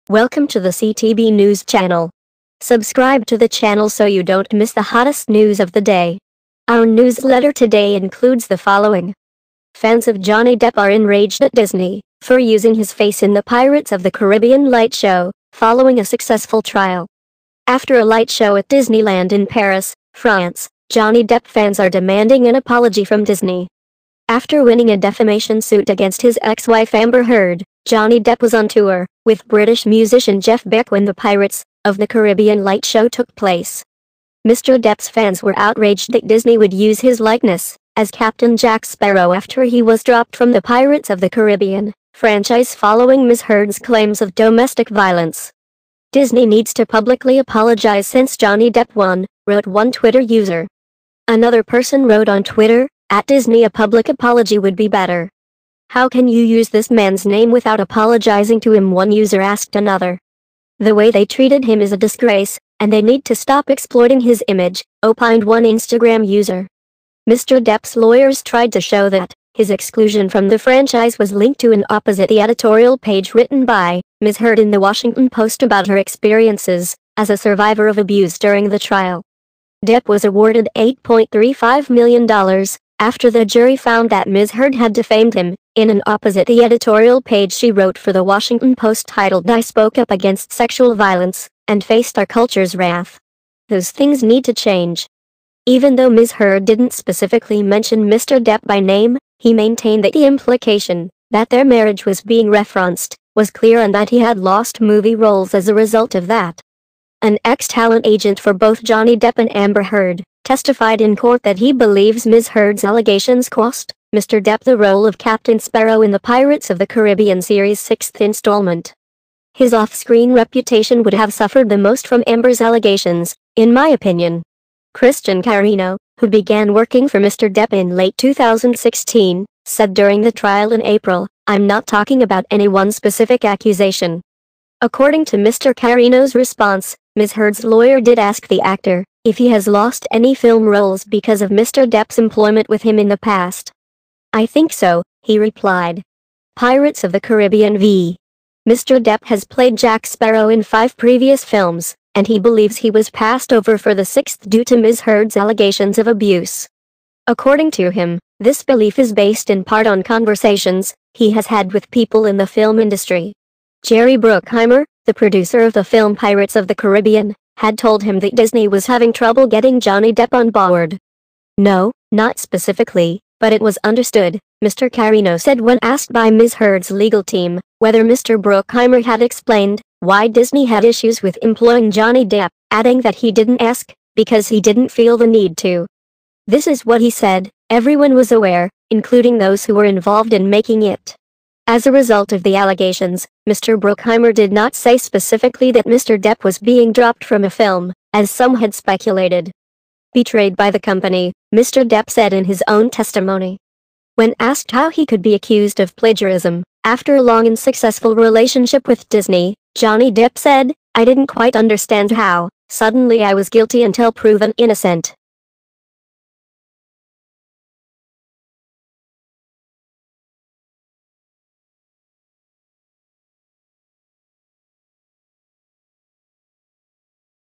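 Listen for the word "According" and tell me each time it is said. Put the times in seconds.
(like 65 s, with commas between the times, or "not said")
134 s, 157 s.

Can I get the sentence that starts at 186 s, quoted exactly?
This is what he said, everyone was aware, including those who were involved in making it.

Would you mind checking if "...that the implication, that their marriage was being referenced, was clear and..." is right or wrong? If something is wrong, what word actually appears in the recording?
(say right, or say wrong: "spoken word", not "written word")
right.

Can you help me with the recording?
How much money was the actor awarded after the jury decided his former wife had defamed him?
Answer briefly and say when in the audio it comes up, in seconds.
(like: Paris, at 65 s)
$8.35 million, at 80 s.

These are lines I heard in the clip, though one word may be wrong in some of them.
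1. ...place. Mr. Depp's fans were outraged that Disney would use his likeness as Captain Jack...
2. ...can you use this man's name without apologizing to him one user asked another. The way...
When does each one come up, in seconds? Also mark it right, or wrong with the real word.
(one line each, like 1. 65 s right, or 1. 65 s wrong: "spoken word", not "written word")
1. 33 s right
2. 56 s right.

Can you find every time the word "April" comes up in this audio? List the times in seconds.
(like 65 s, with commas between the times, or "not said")
130 s.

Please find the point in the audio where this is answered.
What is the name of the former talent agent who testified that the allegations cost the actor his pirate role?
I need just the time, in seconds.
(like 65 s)
124 s.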